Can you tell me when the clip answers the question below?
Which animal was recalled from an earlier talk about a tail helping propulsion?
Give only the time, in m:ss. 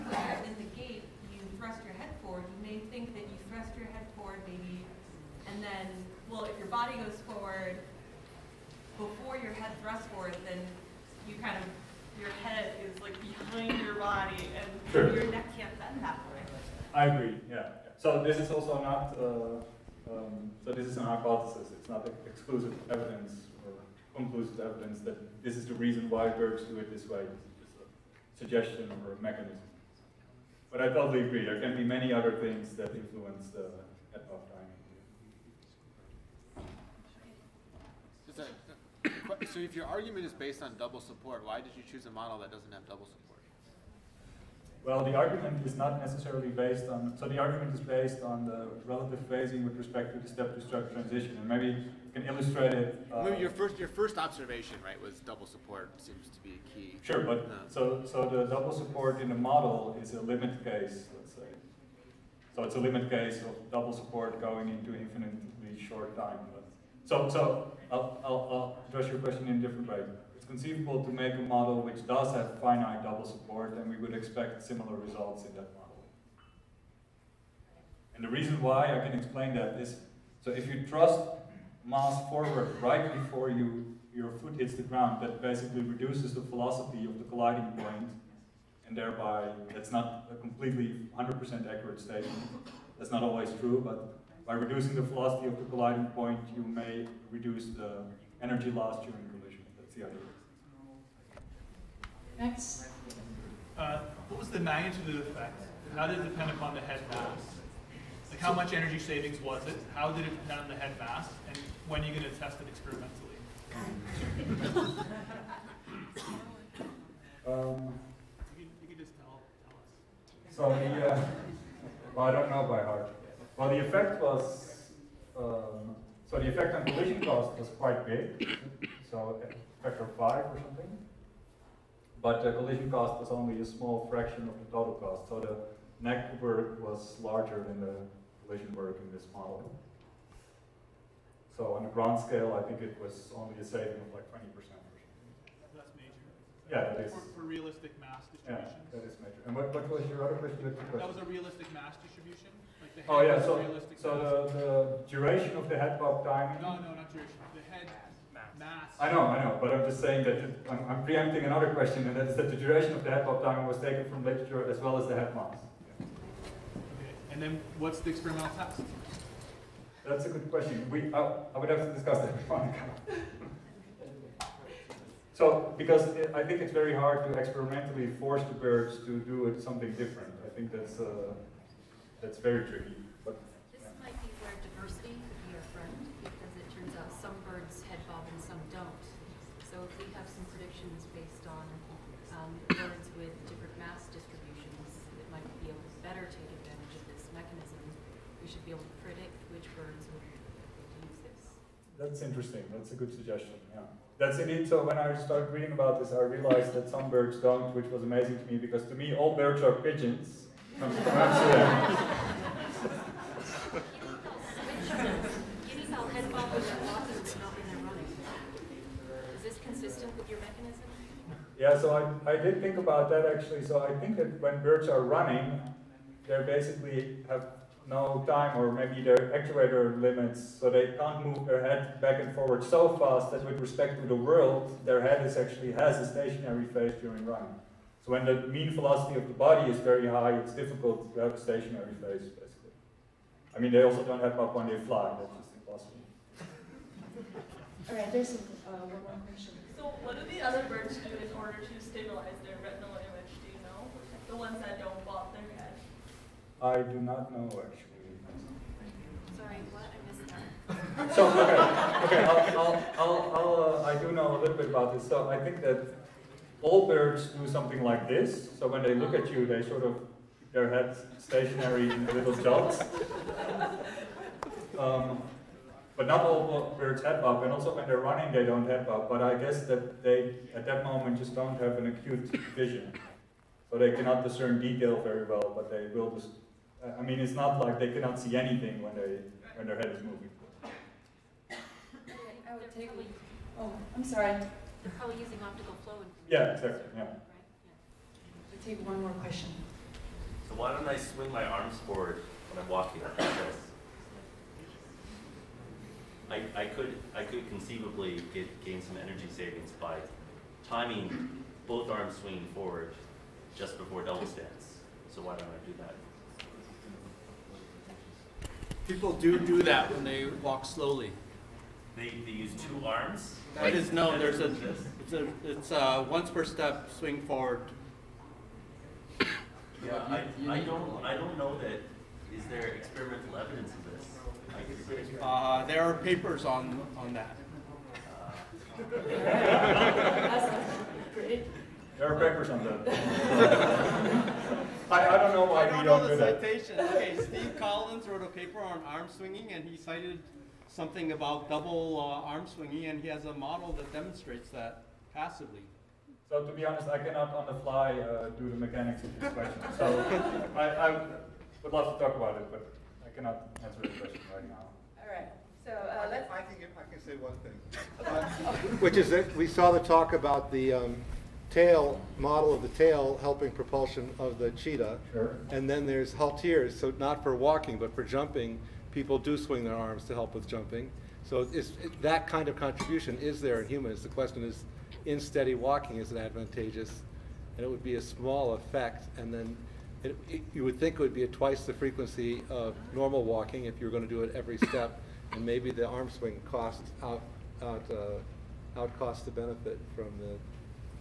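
6:14.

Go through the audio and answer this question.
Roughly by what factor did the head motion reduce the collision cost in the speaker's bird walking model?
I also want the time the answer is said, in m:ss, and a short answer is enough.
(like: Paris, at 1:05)
5, at 2:09.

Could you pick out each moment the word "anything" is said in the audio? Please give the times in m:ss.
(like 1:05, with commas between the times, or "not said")
4:48.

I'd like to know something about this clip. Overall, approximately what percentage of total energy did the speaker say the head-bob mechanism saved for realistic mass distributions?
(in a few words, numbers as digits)
20%.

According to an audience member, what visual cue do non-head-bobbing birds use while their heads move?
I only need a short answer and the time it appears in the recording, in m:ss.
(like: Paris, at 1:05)
optical flow, at 4:55.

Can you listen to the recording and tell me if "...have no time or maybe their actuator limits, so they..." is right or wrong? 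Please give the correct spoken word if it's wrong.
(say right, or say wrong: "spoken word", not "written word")
right.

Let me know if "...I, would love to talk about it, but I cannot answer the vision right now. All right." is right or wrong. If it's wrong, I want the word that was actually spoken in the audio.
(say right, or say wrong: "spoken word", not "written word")
wrong: "question", not "vision".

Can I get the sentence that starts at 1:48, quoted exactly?
Like how much energy savings was it?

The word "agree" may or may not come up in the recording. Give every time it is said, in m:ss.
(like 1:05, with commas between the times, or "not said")
0:17, 0:31.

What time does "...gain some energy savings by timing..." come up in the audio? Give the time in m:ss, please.
5:08.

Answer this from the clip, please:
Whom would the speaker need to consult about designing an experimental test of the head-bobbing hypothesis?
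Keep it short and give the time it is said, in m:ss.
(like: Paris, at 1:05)
Monica, at 2:52.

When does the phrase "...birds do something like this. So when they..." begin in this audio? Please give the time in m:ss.
4:26.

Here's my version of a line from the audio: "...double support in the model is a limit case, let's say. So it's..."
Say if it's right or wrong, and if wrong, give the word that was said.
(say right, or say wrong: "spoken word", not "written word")
right.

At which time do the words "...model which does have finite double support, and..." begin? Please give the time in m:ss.
1:11.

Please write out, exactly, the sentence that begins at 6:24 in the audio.
The question is, in steady walking, is it advantageous?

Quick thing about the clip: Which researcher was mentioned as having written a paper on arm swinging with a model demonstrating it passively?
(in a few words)
Steve Collins.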